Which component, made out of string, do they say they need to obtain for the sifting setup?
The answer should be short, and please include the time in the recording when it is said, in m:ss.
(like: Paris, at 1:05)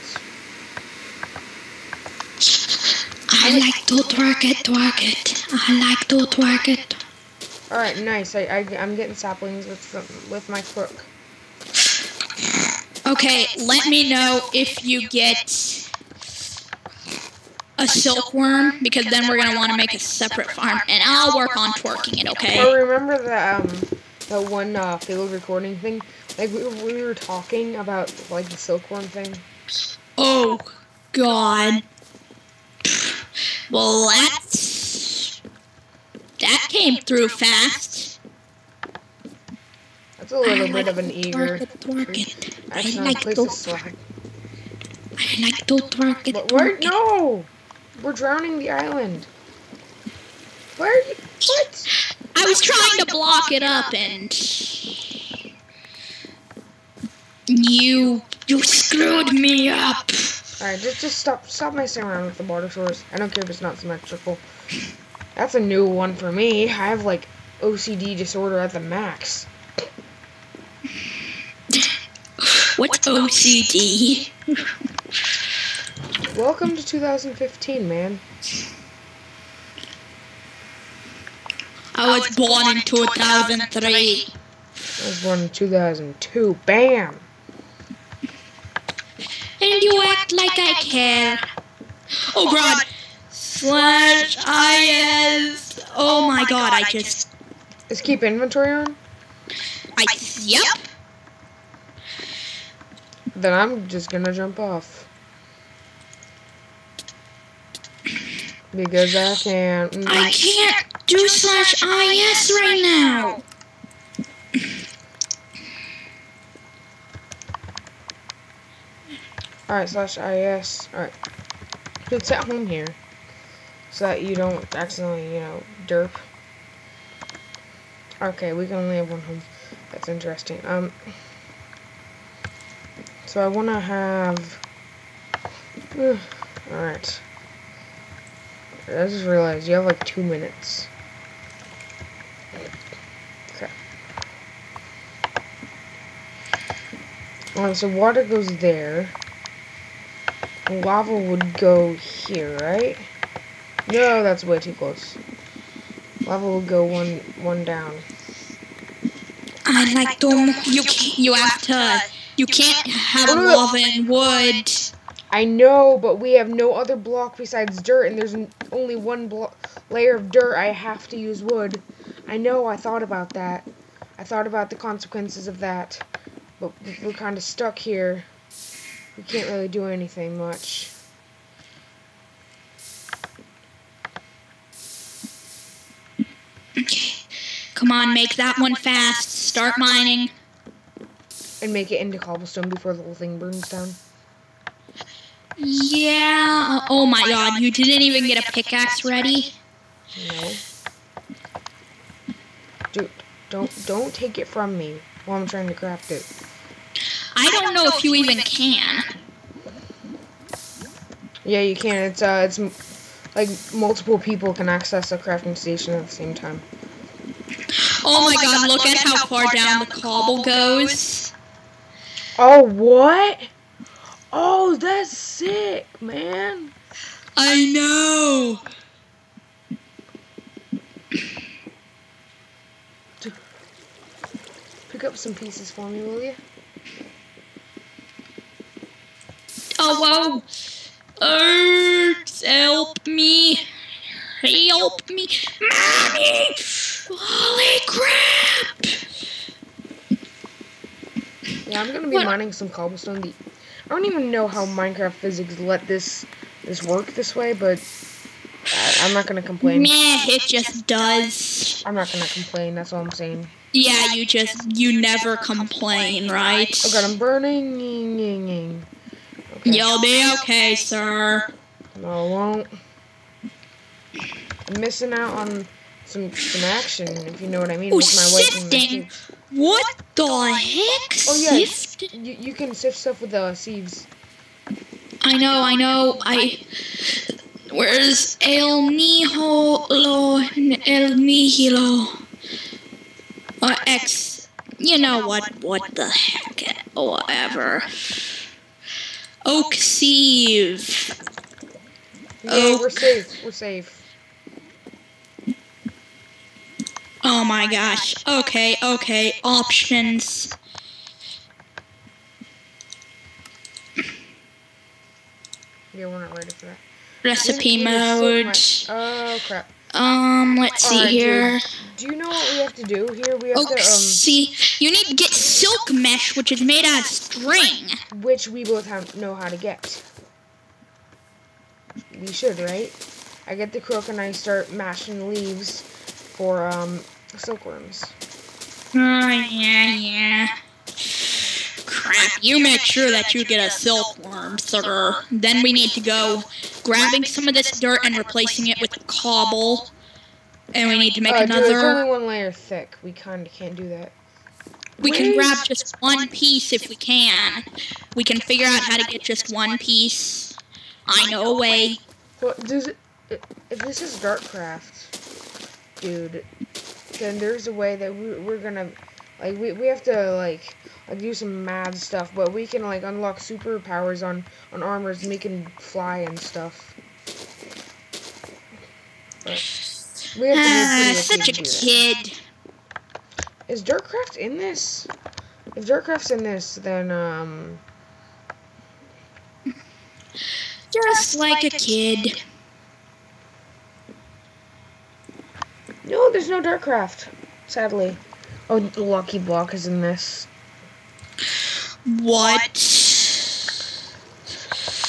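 silk mesh, at 5:25.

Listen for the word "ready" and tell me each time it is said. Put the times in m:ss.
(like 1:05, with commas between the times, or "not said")
3:19, 5:16.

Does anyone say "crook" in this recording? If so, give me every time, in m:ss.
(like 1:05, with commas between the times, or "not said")
0:10, 5:33.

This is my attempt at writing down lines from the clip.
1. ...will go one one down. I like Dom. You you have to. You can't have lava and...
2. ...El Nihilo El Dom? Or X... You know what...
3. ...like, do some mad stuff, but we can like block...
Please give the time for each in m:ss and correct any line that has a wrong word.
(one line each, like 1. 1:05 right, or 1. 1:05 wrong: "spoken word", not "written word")
1. 2:36 right
2. 4:48 wrong: "Nihilo", not "Dom"
3. 6:10 wrong: "unlock", not "block".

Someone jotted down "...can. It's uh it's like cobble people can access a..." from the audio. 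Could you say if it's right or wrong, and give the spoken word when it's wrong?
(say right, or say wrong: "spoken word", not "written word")
wrong: "multiple", not "cobble".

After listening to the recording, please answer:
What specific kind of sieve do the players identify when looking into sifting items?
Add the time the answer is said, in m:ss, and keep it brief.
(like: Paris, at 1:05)
Oak Sieve, at 4:59.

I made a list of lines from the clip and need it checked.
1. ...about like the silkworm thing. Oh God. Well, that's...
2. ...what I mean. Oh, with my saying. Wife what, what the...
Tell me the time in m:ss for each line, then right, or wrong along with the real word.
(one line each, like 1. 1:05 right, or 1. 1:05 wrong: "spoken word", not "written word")
1. 0:27 right
2. 4:37 wrong: "shifting", not "saying".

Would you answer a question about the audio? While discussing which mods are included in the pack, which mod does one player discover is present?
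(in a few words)
Lucky Block.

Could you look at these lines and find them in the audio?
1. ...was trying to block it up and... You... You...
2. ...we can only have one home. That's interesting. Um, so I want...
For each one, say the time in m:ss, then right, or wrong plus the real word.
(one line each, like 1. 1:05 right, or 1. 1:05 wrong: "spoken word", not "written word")
1. 0:52 right
2. 2:08 right.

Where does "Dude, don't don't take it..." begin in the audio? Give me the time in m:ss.
3:22.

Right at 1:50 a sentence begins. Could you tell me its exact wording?
I can't do slash IS right now.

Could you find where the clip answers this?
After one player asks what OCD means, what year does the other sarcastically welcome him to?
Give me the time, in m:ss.
1:16.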